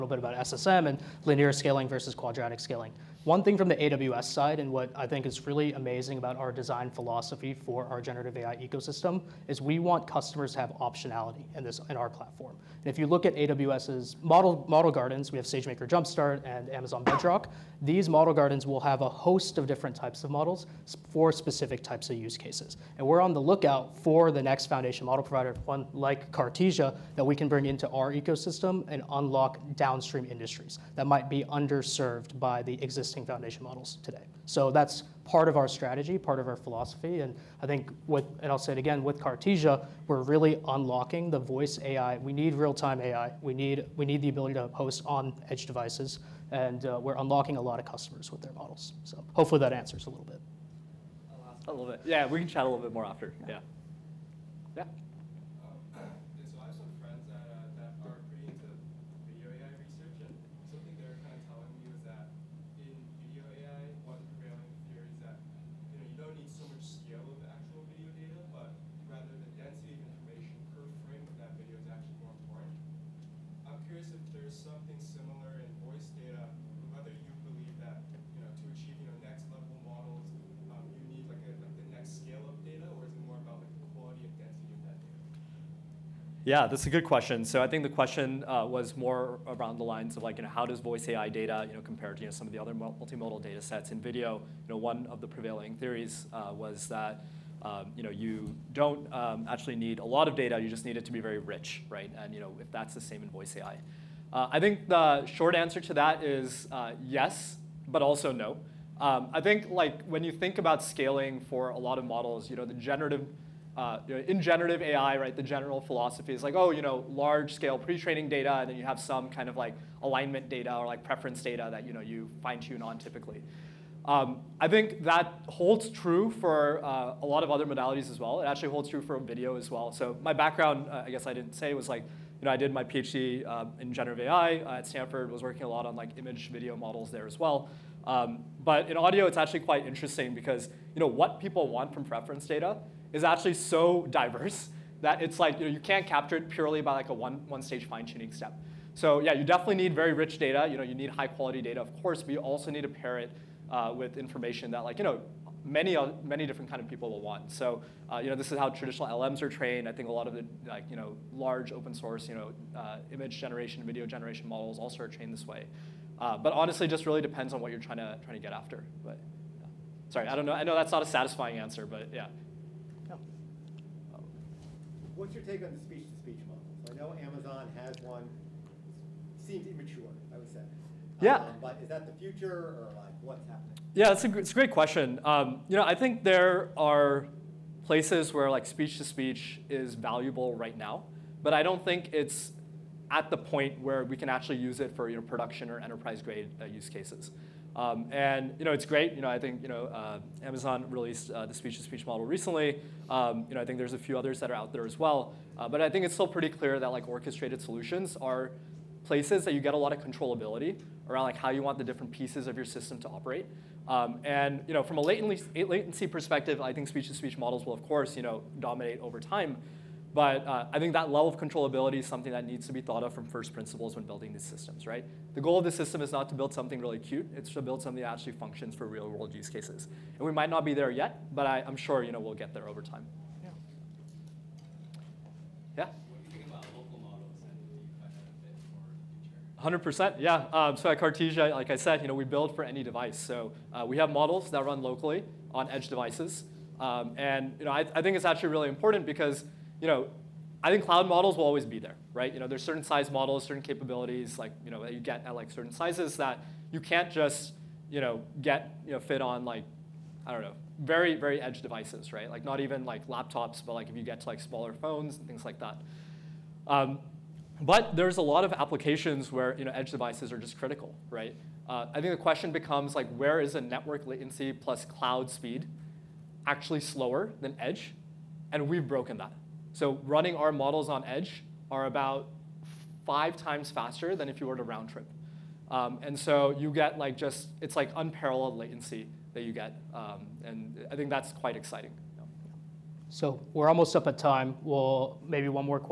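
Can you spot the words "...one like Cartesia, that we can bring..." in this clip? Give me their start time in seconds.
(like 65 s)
25 s.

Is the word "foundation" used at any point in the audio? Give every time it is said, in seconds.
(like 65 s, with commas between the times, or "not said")
24 s, 33 s.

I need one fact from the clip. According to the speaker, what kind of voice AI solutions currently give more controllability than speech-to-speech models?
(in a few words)
orchestrated solutions.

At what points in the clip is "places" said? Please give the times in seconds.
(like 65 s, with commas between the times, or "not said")
187 s, 209 s.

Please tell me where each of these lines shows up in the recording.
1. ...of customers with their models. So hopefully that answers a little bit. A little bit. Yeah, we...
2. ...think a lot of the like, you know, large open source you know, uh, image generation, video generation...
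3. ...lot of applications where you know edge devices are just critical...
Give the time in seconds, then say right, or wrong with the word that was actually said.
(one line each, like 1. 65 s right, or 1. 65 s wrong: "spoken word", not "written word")
1. 47 s right
2. 159 s right
3. 268 s right.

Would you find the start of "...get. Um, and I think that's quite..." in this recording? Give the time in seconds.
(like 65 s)
289 s.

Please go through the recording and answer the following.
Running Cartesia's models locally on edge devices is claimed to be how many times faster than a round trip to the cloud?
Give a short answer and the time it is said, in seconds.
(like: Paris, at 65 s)
5, at 283 s.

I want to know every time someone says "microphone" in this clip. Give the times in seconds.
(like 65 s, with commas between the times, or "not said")
not said.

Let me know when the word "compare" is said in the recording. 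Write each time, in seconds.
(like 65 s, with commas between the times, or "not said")
91 s.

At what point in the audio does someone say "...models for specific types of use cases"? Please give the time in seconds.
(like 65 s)
20 s.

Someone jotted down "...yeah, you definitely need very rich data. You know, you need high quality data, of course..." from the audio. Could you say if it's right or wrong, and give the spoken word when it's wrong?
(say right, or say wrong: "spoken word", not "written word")
right.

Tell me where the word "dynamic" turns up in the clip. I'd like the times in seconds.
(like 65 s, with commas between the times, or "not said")
not said.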